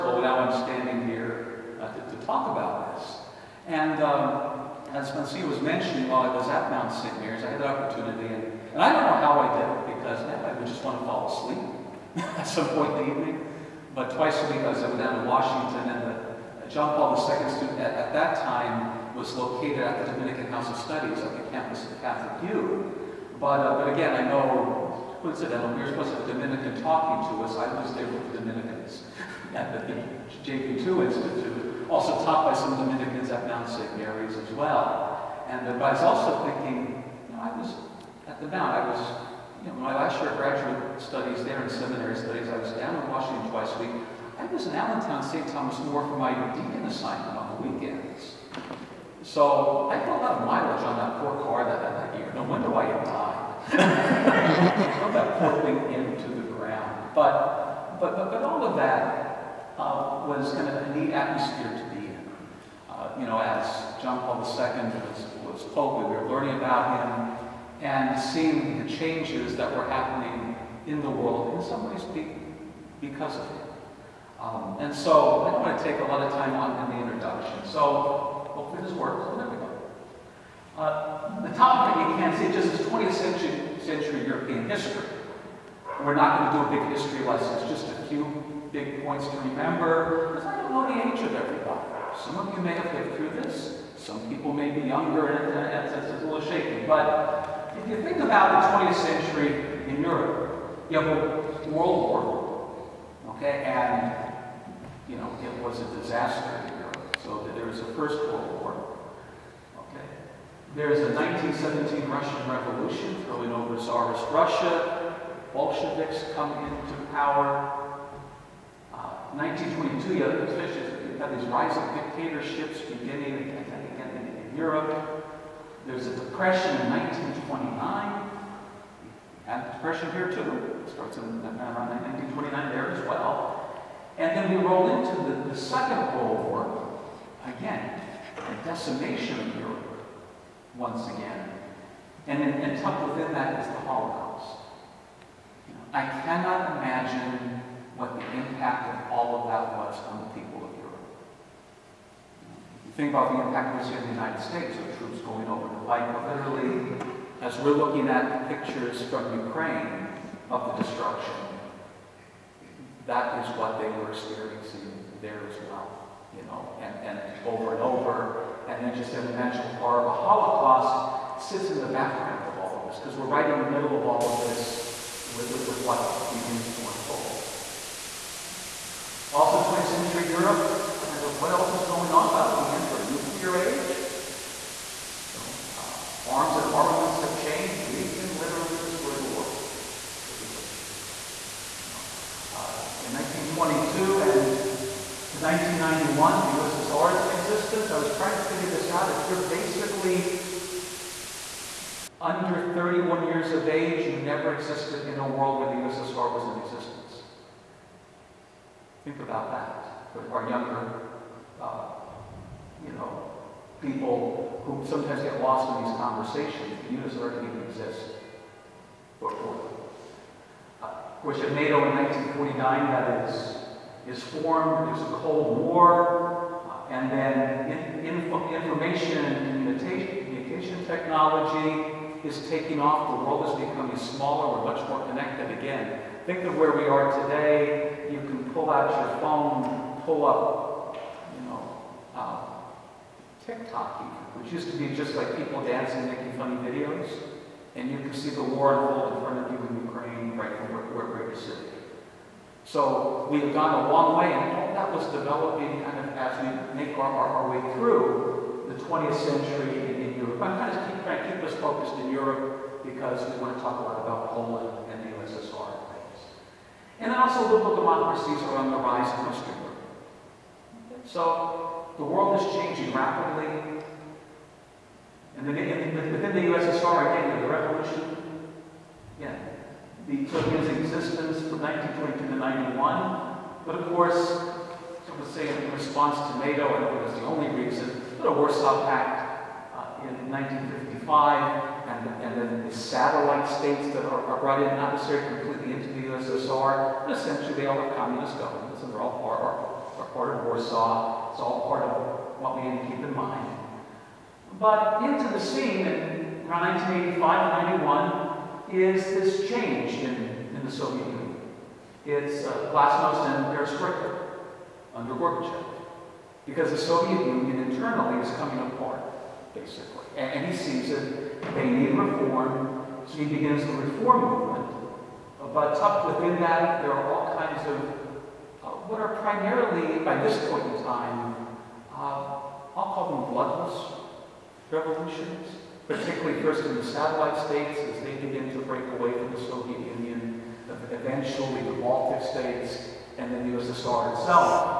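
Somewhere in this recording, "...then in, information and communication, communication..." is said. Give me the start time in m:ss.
3:47.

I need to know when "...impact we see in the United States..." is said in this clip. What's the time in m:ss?
2:33.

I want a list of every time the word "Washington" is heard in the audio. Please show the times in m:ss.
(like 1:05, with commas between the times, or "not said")
0:15, 0:43.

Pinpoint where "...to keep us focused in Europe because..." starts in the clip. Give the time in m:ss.
4:21.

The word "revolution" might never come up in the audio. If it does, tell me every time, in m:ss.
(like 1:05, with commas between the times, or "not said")
1:52, 4:37, 5:34.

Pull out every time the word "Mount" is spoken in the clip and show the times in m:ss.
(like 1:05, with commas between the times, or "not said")
0:06, 0:33, 0:38.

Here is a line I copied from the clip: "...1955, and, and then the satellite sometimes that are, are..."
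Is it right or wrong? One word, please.
wrong.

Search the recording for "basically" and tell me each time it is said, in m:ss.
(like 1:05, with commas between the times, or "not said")
3:19, 5:19.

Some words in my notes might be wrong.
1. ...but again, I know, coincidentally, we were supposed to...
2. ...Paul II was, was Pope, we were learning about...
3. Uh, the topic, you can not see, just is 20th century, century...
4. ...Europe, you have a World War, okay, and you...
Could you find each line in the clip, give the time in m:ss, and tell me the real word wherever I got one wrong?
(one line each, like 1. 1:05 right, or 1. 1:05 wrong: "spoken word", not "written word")
1. 0:23 right
2. 1:04 right
3. 1:20 right
4. 1:40 right.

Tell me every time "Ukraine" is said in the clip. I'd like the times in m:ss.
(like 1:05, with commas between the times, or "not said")
2:39, 4:09.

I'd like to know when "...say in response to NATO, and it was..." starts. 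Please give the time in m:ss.
4:45.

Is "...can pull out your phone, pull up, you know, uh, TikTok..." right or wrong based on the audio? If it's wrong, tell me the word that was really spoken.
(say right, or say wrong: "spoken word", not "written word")
right.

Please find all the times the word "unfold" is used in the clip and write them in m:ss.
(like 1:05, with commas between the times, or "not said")
2:56, 4:08.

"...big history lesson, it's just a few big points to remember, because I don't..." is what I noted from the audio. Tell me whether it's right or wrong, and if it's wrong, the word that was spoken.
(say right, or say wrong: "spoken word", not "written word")
right.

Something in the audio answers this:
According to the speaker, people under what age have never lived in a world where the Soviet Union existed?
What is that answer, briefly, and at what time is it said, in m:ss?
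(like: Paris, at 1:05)
31, at 3:22.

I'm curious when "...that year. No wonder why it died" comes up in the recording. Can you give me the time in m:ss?
0:51.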